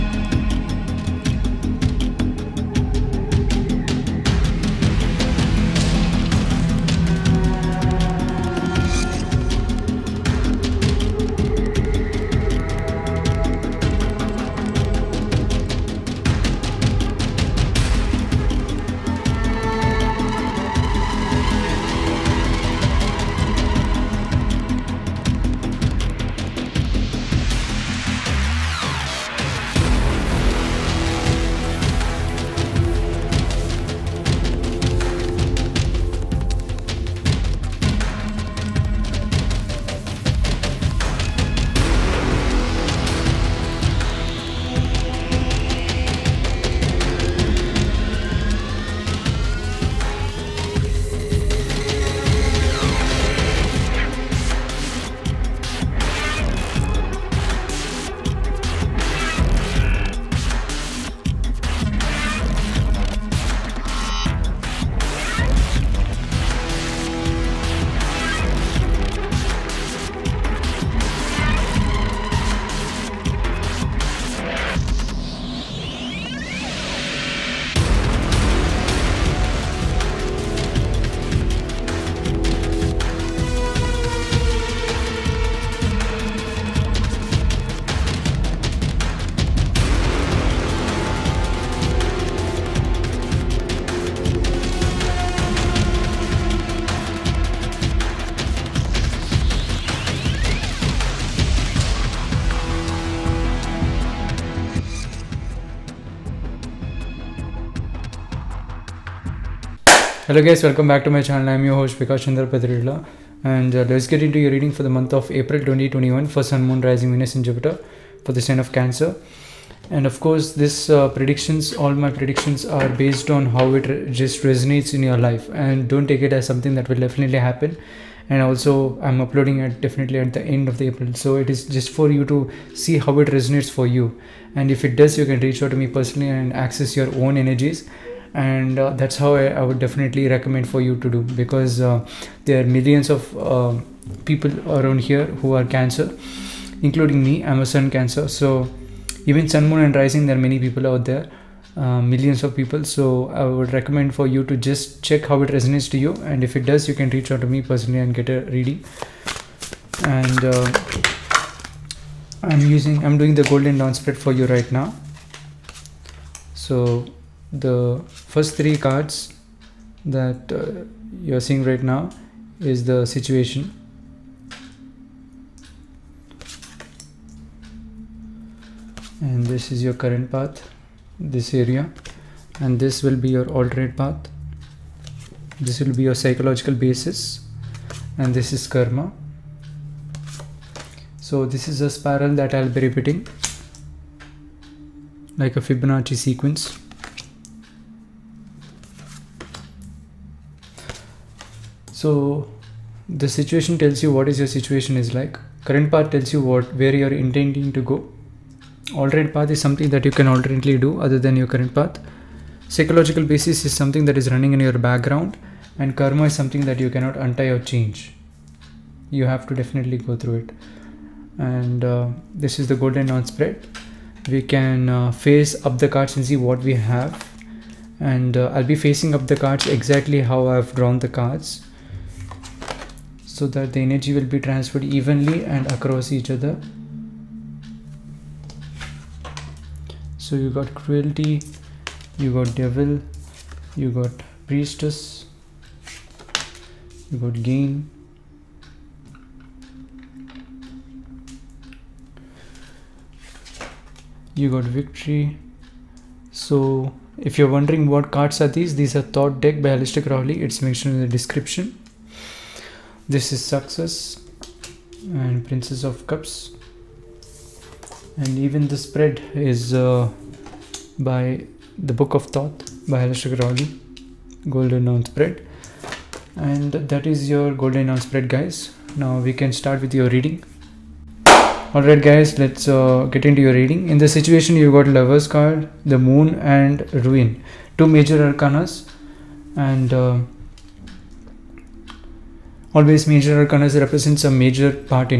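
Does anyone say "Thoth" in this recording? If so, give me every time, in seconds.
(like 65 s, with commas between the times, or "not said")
259 s, 272 s.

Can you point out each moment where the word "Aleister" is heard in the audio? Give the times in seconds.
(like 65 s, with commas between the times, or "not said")
259 s, 273 s.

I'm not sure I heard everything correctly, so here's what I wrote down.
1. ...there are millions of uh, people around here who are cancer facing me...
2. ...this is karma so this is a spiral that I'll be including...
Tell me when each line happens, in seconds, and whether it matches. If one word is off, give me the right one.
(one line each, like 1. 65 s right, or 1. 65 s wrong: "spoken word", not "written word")
1. 142 s wrong: "including", not "facing"
2. 188 s wrong: "repeating", not "including".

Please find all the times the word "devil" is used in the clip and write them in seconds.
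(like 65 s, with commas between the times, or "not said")
242 s.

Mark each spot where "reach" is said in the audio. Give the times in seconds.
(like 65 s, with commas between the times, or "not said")
135 s, 157 s.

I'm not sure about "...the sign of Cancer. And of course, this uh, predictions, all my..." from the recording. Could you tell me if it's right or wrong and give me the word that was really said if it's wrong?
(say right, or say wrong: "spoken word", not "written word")
right.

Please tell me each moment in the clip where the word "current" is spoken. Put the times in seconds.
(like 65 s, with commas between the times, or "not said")
179 s, 205 s, 211 s.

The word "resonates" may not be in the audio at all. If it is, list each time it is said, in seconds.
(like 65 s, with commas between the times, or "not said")
124 s, 133 s, 155 s.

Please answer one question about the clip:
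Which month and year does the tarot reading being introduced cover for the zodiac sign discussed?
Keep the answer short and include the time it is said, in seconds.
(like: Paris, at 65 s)
April 2021, at 115 s.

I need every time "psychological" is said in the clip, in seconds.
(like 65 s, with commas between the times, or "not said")
186 s, 212 s.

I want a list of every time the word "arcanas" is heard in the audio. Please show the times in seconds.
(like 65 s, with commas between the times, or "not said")
288 s, 293 s.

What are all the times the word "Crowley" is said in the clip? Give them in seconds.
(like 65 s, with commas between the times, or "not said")
260 s, 273 s.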